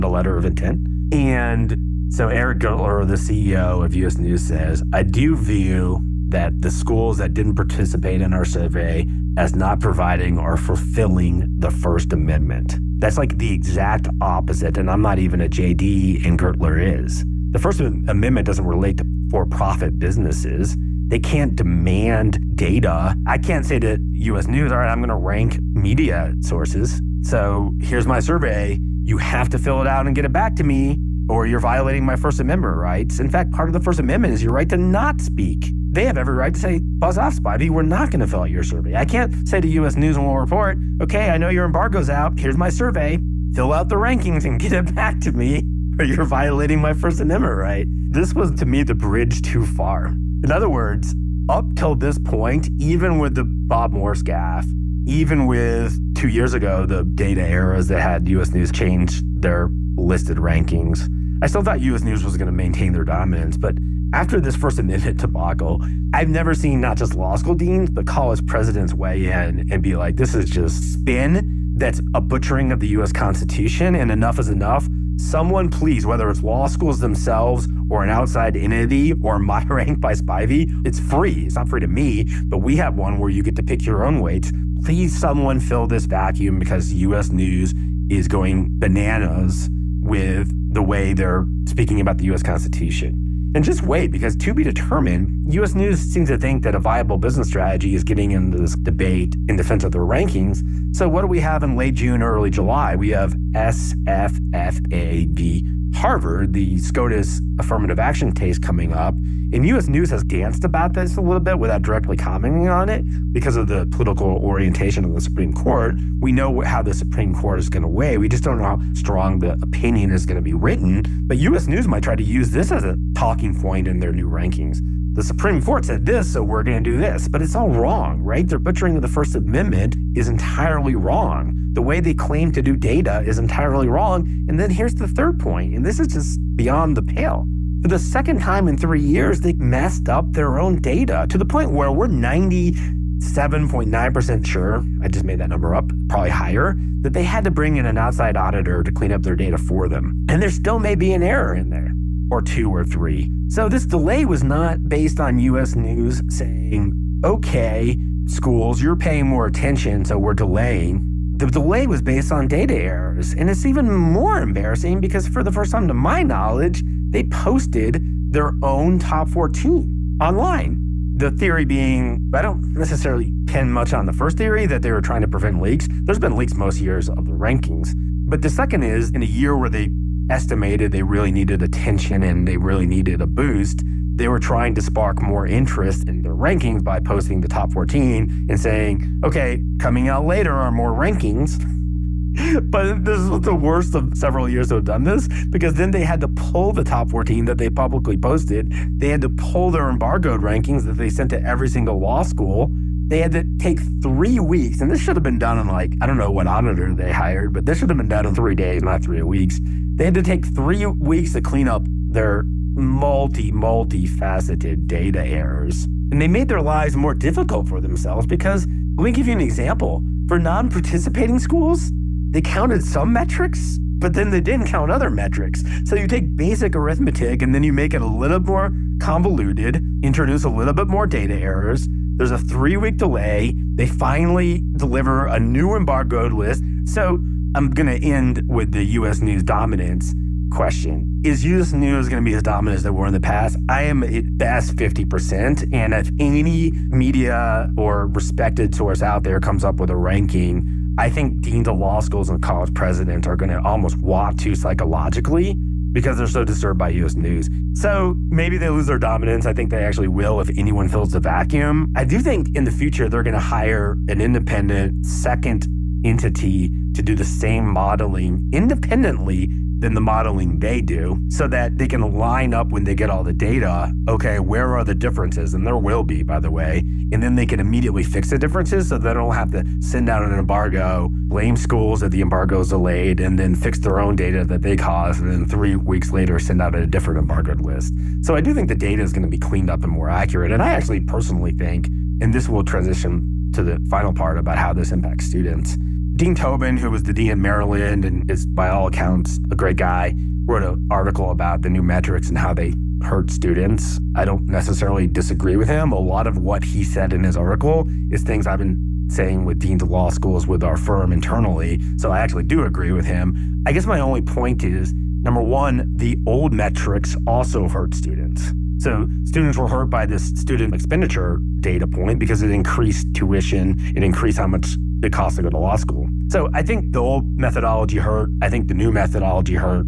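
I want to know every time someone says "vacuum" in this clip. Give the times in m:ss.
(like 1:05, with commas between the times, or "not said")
1:26, 4:21.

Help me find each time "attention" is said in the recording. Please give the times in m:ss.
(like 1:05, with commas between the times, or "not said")
2:39, 3:01.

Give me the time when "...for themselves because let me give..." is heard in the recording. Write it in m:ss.
3:37.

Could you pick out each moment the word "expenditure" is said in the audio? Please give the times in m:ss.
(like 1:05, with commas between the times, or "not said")
5:20.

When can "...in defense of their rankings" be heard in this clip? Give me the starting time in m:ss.
1:39.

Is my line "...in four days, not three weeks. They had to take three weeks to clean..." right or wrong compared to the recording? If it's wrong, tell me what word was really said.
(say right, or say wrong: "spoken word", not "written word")
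wrong: "three", not "four".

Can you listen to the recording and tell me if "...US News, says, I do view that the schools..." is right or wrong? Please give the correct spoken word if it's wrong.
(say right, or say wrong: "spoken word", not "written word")
right.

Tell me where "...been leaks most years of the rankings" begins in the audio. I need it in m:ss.
2:56.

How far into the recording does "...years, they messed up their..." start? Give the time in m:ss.
2:19.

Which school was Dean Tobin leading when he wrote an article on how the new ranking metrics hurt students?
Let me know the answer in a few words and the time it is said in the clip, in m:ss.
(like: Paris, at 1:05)
Maryland, at 4:57.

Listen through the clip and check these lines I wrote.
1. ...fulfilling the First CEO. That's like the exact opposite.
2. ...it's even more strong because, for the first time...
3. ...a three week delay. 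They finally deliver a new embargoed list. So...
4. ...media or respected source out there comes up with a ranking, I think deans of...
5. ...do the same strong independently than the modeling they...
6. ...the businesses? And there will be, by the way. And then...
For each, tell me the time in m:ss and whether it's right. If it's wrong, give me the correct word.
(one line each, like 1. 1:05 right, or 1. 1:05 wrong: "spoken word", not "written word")
1. 0:10 wrong: "Amendment", not "CEO"
2. 2:43 wrong: "embarrassing", not "strong"
3. 3:52 right
4. 4:06 right
5. 4:27 wrong: "modeling", not "strong"
6. 4:34 wrong: "differences", not "businesses".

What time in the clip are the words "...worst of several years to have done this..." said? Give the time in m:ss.
3:13.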